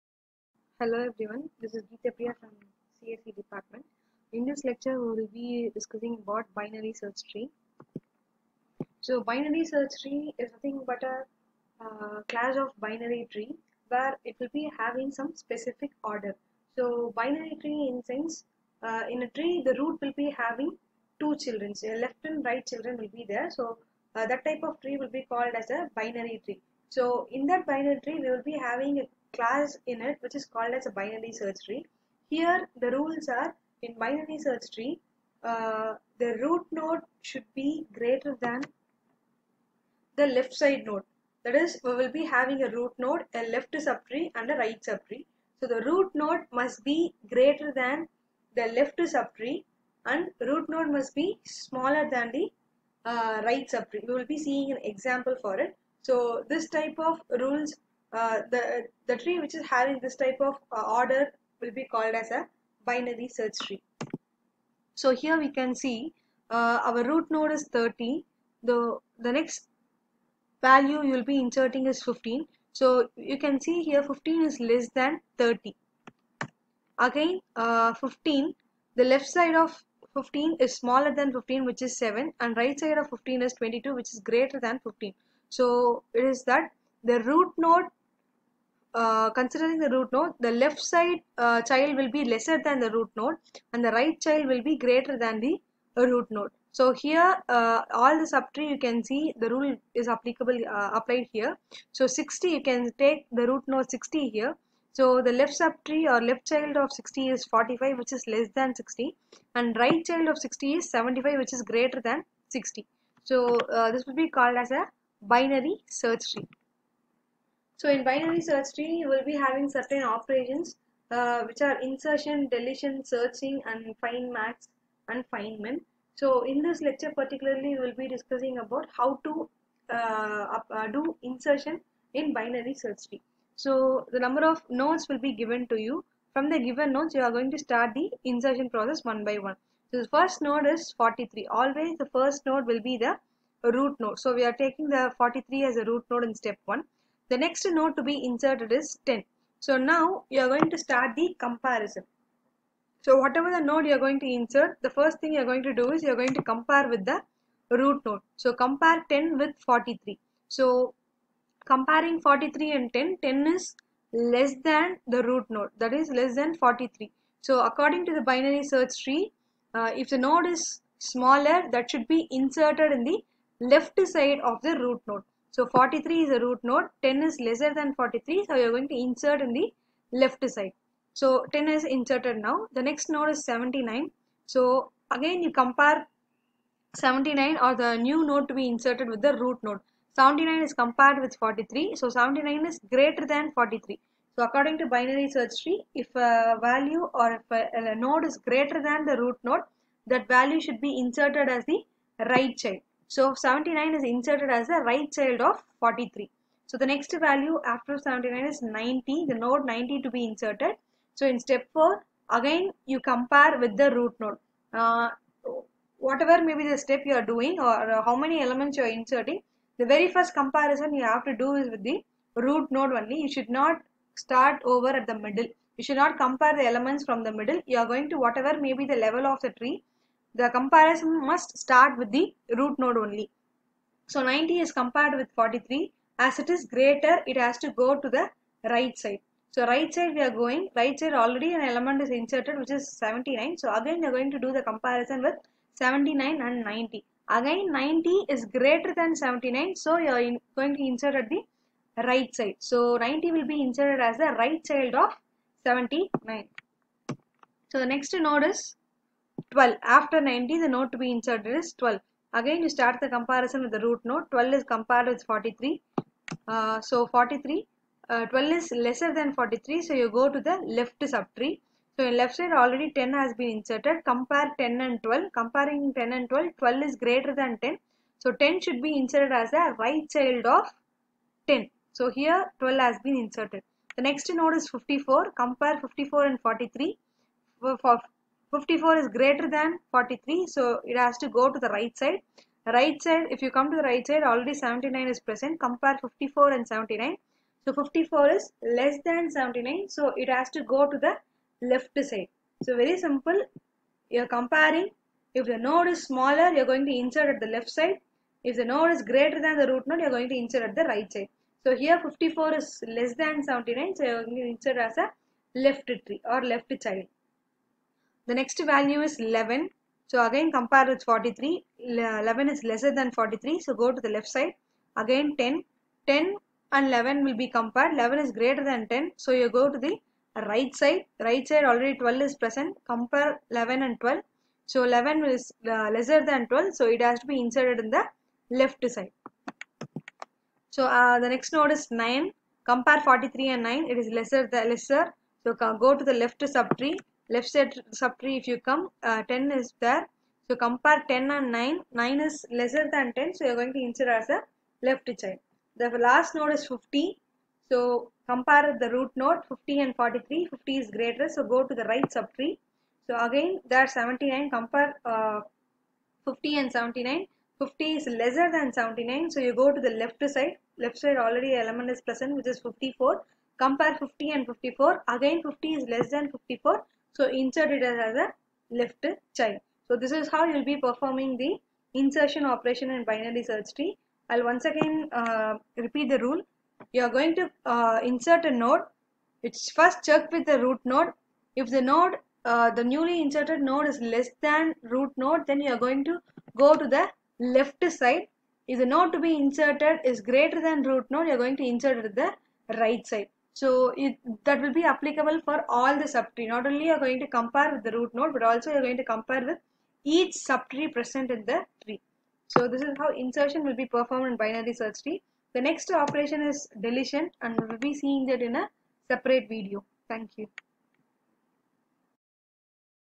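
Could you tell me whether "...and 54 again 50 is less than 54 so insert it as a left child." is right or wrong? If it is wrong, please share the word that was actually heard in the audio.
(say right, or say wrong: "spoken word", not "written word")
right.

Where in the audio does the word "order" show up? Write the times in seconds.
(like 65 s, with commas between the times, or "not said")
16 s, 60 s.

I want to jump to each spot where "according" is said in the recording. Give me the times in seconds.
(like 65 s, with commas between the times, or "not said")
167 s, 194 s.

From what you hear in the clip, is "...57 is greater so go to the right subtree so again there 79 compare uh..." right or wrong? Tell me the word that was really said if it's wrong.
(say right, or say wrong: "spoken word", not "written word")
wrong: "50", not "57".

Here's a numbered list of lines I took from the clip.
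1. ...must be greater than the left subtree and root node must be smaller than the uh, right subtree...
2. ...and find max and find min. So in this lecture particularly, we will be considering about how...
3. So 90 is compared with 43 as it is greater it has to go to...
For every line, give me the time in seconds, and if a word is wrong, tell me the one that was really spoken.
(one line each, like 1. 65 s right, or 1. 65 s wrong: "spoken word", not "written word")
1. 46 s right
2. 123 s wrong: "discussing", not "considering"
3. 234 s right.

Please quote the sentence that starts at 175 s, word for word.
So 43 is a root node, 10 is lesser than 43, so you're going to insert in the left side.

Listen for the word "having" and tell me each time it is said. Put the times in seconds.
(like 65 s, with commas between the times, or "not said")
14 s, 20 s, 28 s, 42 s, 59 s, 119 s.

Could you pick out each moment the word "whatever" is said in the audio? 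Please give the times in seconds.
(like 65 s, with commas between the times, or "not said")
153 s, 215 s, 228 s.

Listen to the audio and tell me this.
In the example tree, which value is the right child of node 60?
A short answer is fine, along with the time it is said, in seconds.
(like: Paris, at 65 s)
75, at 110 s.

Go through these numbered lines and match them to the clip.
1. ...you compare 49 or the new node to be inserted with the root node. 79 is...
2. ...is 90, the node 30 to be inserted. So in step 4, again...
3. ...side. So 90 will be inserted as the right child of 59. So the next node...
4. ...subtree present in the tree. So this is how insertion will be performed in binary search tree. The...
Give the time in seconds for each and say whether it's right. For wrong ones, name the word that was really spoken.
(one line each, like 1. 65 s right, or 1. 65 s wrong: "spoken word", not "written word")
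1. 185 s wrong: "79", not "49"
2. 208 s wrong: "90", not "30"
3. 252 s wrong: "79", not "59"
4. 410 s right.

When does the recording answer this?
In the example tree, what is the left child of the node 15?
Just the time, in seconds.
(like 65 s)
81 s.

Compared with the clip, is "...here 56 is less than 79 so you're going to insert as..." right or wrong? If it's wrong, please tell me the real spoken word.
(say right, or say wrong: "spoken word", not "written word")
wrong: "54", not "56".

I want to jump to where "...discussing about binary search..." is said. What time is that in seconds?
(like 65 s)
5 s.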